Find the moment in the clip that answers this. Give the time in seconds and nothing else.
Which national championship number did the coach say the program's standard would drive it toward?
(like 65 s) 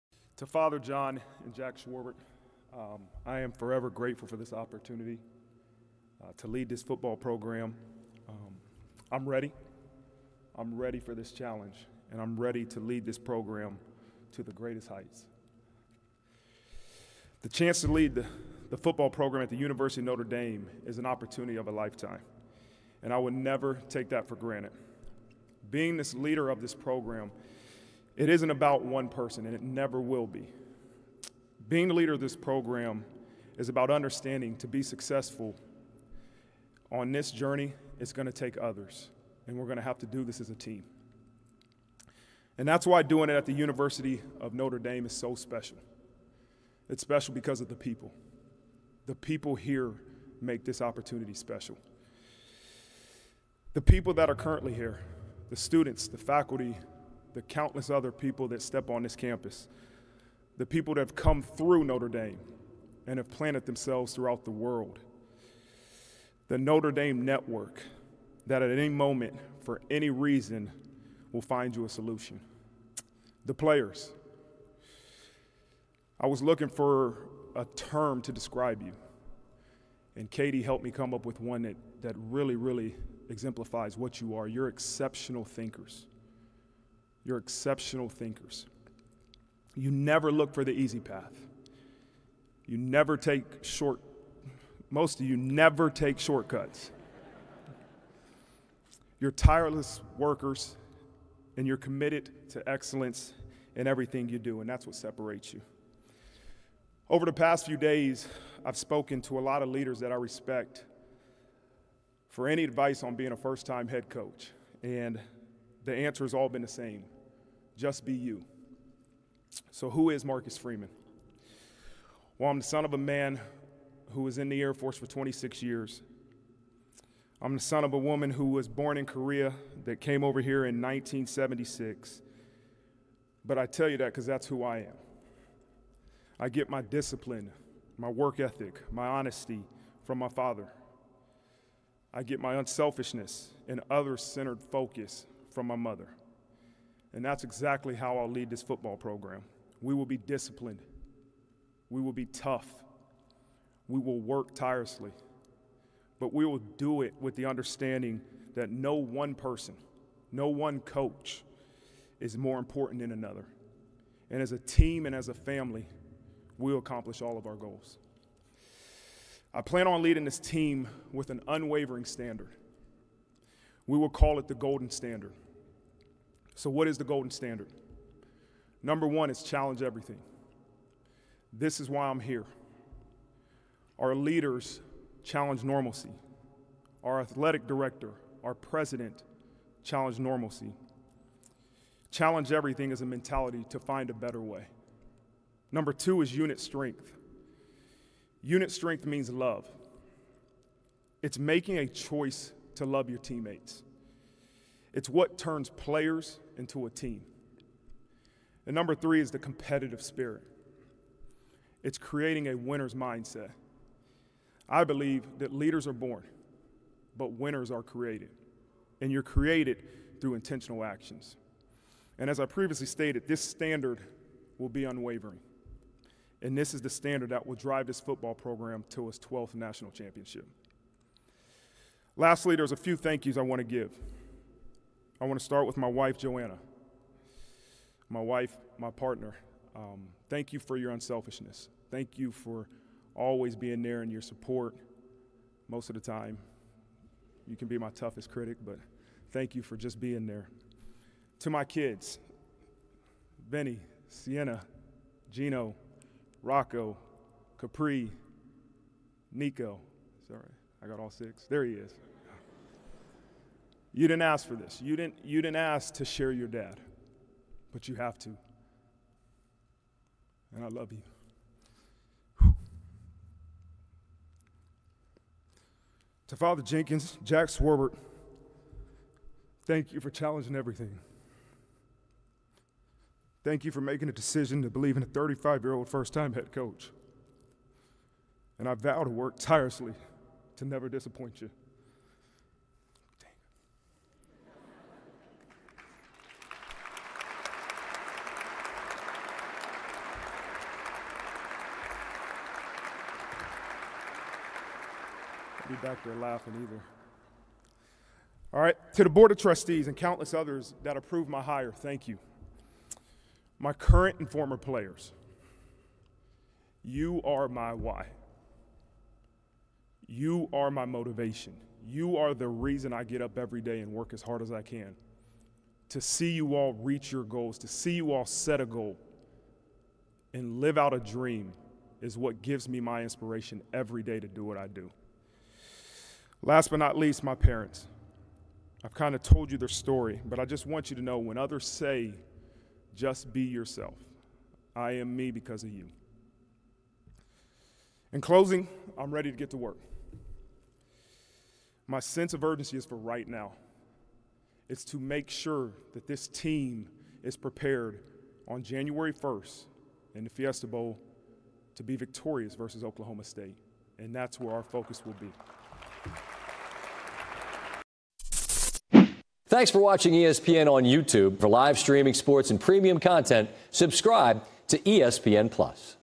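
229 s.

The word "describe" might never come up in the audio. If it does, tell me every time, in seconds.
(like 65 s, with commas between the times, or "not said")
78 s.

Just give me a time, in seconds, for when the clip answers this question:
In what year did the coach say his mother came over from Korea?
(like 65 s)
130 s.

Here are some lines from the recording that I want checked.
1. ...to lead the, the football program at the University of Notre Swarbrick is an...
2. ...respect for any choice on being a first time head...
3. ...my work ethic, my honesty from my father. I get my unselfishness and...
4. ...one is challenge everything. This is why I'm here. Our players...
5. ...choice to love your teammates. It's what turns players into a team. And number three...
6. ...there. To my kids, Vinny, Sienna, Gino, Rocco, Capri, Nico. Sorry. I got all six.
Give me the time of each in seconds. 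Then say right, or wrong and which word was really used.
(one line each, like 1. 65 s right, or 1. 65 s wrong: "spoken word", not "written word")
1. 17 s wrong: "Dame", not "Swarbrick"
2. 110 s wrong: "advice", not "choice"
3. 137 s right
4. 179 s wrong: "leaders", not "players"
5. 201 s right
6. 250 s right.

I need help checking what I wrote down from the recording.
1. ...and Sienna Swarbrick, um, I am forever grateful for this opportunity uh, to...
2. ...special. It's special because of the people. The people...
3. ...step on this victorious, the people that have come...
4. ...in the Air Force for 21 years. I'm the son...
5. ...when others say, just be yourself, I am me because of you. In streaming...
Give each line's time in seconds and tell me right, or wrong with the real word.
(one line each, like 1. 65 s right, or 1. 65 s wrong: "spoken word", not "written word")
1. 1 s wrong: "Jack", not "Sienna"
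2. 45 s right
3. 58 s wrong: "campus", not "victorious"
4. 124 s wrong: "26", not "21"
5. 341 s wrong: "closing", not "streaming".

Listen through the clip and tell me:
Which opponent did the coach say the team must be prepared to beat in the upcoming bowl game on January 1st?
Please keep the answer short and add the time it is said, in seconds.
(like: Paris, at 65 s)
Oklahoma State, at 362 s.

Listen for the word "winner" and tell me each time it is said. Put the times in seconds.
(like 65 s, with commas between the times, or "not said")
212 s, 217 s.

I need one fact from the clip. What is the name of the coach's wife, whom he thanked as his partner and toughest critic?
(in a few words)
Joanna.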